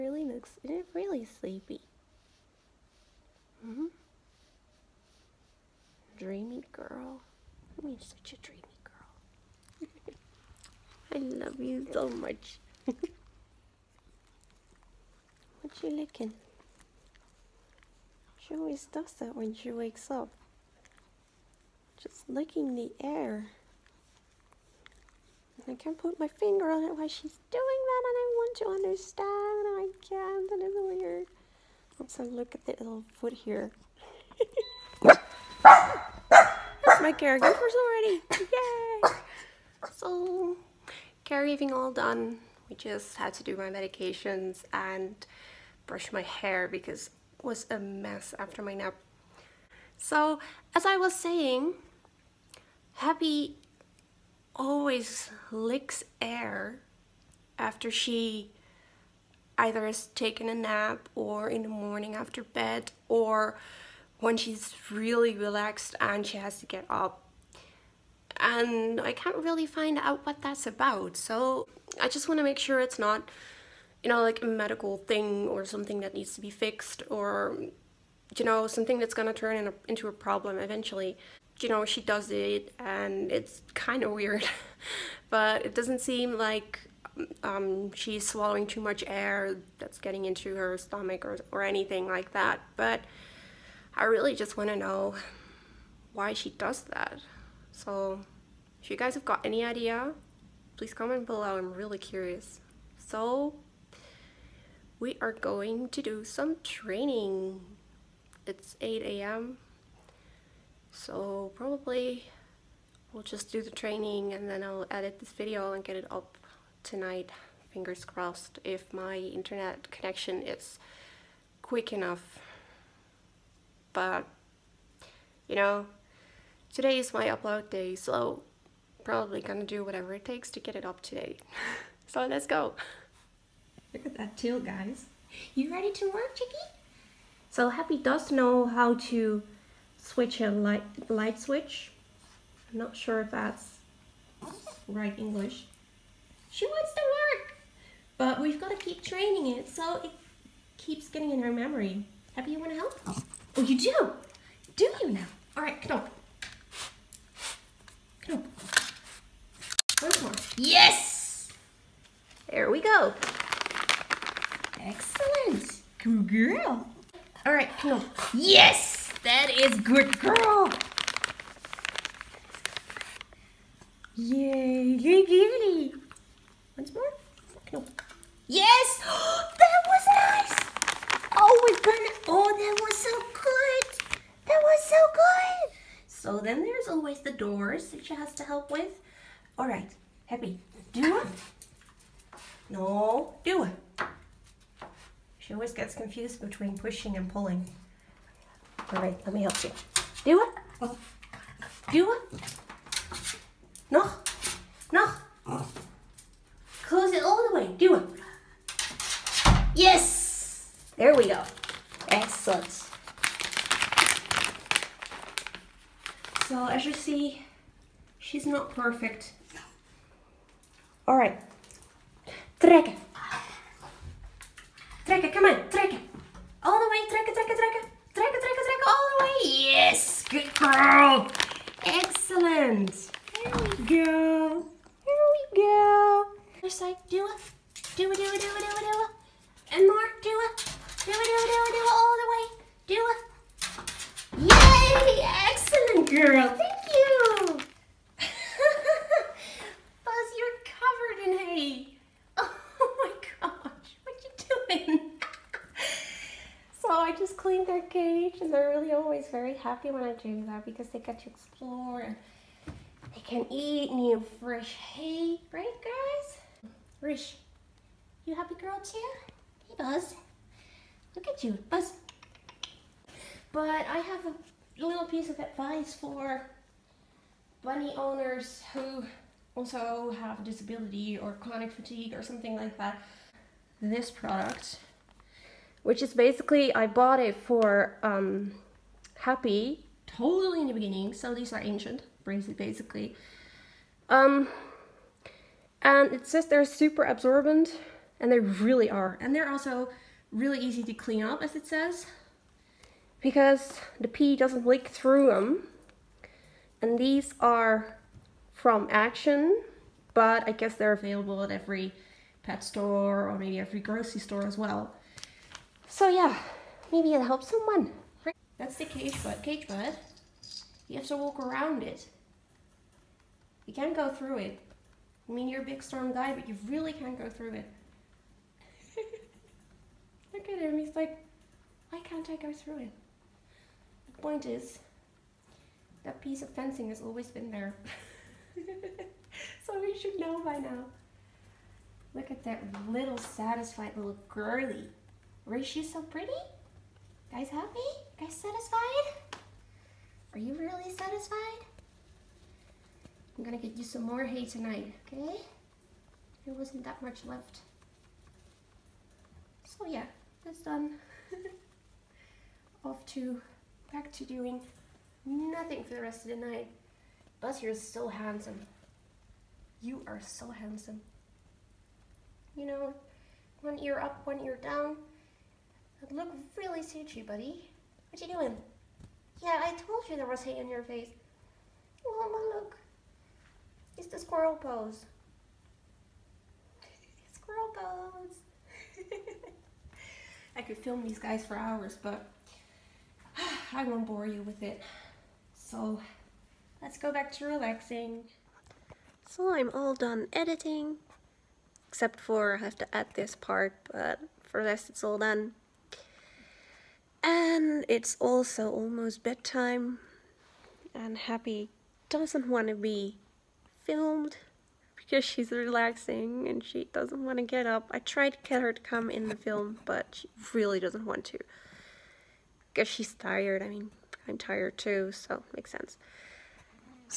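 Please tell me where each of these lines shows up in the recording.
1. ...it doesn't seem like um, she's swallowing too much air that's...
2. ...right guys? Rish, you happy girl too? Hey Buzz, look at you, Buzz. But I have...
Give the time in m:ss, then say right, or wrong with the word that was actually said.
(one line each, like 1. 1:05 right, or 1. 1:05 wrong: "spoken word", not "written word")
1. 1:25 right
2. 4:25 right.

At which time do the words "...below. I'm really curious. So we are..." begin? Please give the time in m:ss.
1:41.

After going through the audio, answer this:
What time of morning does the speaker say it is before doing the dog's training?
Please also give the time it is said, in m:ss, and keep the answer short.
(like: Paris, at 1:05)
8 a.m., at 1:48.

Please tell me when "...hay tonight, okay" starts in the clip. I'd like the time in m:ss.
5:54.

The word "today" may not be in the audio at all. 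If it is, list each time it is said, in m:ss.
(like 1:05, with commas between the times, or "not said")
2:06, 2:11.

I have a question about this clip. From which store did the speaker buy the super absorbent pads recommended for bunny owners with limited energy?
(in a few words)
Action.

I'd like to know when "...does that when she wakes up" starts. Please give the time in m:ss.
0:18.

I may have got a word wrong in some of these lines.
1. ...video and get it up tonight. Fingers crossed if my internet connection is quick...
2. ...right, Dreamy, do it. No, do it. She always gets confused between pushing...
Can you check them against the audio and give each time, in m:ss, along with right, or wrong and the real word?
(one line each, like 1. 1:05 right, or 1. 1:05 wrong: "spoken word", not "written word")
1. 1:55 right
2. 3:09 wrong: "Happy", not "Dreamy".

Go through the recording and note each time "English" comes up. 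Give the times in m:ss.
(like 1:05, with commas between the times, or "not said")
2:25.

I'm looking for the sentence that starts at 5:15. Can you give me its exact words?
So yeah, maybe it'll help someone.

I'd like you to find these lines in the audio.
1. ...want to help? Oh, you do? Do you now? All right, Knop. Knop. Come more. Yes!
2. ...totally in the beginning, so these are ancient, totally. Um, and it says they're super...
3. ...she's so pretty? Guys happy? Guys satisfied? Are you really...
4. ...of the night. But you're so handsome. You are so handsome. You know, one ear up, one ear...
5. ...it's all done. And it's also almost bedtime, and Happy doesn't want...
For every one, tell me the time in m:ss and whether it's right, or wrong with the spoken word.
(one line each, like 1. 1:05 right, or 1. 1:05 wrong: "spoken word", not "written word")
1. 2:32 right
2. 4:50 wrong: "basically", not "totally"
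3. 5:45 right
4. 6:06 right
5. 6:44 right.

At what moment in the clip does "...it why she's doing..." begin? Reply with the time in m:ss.
0:26.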